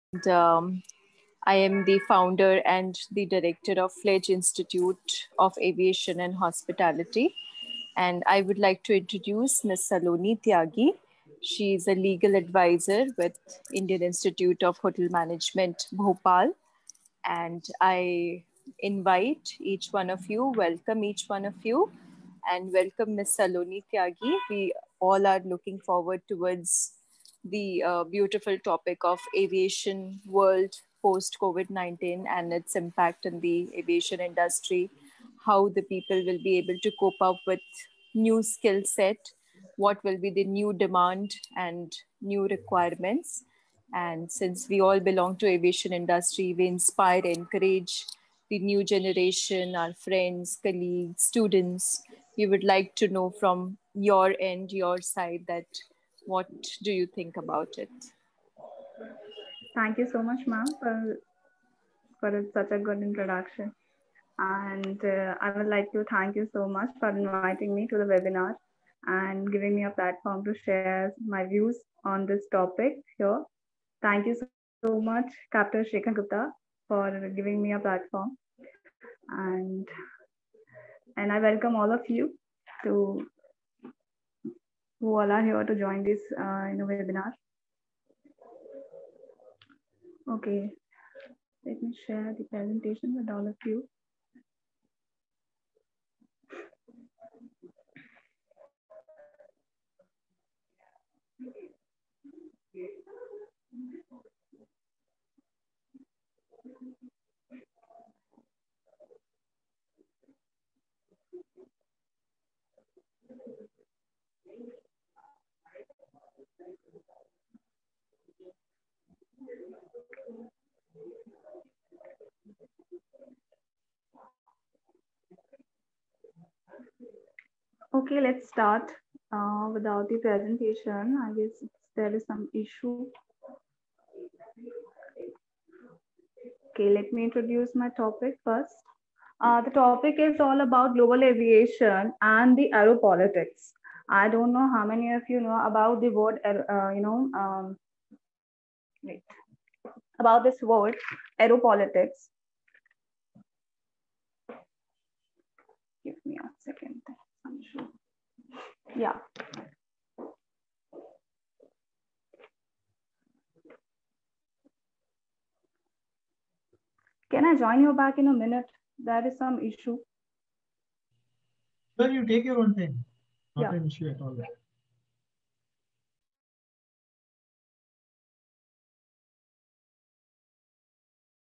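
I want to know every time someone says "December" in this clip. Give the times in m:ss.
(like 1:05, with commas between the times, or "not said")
not said.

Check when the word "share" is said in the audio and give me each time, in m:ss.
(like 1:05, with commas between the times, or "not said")
1:10, 1:32.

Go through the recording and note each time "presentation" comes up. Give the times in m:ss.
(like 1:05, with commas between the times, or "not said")
1:32, 2:10.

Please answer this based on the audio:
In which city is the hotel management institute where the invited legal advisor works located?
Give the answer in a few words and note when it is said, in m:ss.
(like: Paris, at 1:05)
Bhopal, at 0:15.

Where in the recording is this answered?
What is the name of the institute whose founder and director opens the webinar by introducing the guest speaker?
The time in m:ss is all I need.
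0:03.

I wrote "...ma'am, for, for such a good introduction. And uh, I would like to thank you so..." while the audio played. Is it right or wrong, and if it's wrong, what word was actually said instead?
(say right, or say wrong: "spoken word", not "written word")
right.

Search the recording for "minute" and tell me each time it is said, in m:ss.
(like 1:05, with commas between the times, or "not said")
2:48.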